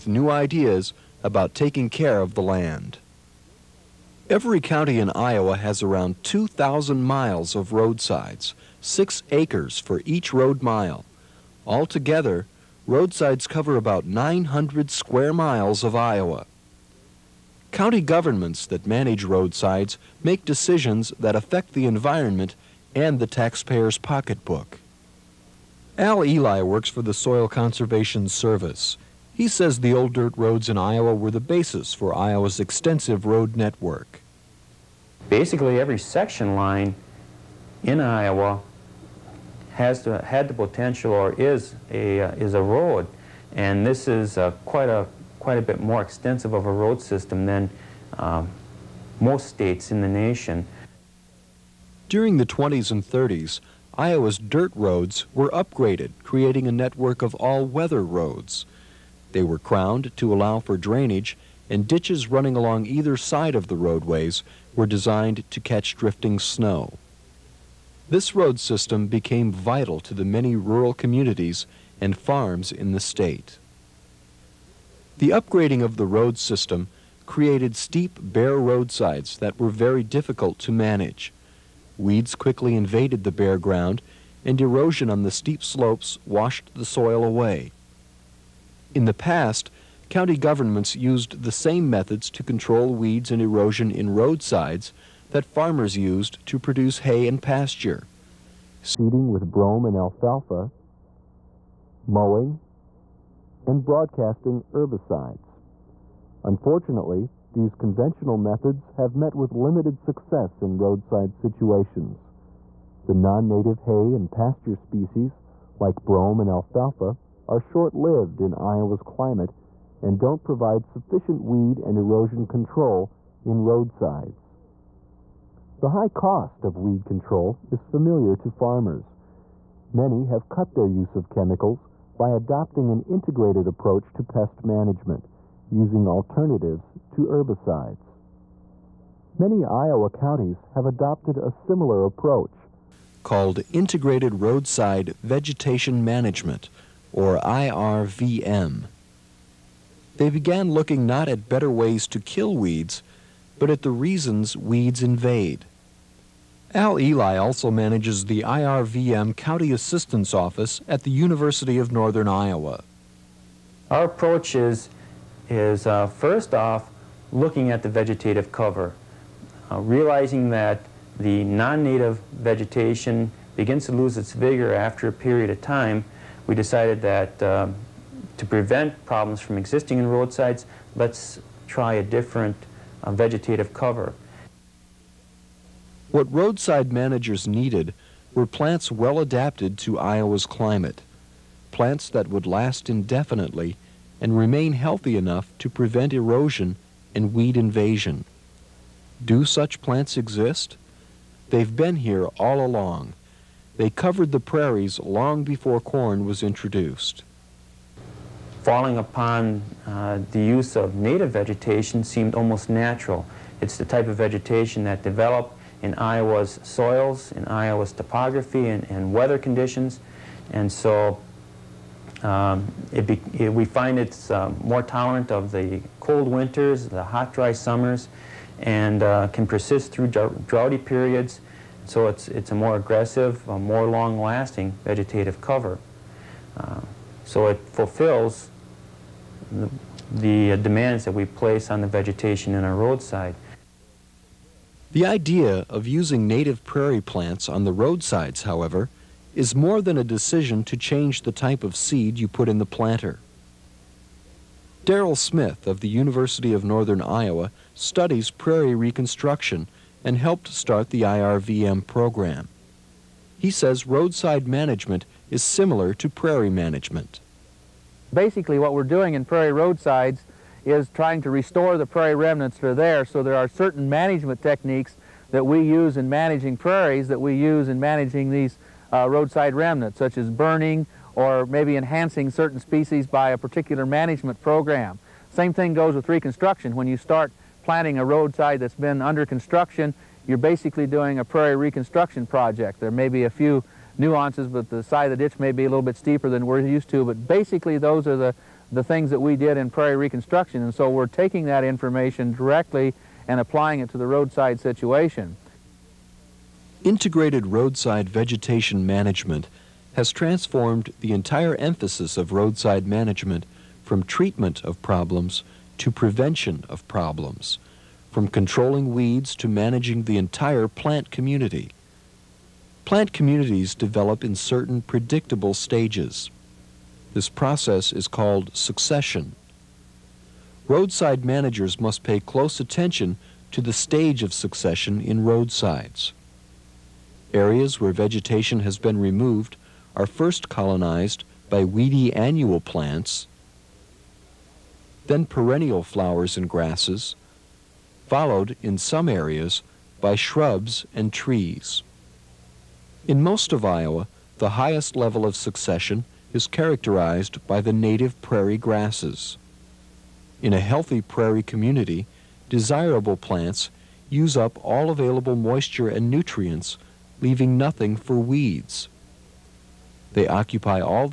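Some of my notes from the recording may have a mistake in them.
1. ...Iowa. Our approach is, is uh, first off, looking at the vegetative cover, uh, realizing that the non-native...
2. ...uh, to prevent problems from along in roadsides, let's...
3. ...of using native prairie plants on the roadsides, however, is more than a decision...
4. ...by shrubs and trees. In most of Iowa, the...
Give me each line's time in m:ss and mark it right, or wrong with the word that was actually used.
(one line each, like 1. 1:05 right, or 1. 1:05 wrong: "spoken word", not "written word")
1. 2:42 right
2. 2:57 wrong: "existing", not "along"
3. 4:05 right
4. 5:49 right.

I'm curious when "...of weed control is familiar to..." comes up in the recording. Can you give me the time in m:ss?
2:06.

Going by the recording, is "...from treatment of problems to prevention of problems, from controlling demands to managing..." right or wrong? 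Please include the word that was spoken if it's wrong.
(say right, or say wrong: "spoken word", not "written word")
wrong: "weeds", not "demands".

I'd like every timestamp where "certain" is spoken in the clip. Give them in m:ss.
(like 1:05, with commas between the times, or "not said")
4:33, 4:42, 5:24.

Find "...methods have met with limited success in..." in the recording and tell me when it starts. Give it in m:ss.
1:48.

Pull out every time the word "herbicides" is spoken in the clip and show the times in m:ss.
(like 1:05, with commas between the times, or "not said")
1:44, 2:17.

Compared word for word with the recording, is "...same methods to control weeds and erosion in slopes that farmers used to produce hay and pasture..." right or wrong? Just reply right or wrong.
wrong.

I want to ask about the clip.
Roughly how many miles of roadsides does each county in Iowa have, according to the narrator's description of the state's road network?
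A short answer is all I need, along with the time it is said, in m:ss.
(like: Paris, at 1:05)
2,000, at 0:06.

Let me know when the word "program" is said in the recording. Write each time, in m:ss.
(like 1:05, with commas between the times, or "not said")
4:21, 4:44.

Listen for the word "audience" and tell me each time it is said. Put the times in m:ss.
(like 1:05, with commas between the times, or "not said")
not said.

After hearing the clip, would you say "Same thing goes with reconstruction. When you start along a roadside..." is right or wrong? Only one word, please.
wrong.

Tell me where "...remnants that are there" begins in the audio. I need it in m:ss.
4:32.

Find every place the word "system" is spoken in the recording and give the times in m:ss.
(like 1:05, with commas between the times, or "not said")
0:46, 1:08, 1:16.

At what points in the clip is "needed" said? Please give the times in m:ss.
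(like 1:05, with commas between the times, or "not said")
3:07.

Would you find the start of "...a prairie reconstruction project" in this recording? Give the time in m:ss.
4:51.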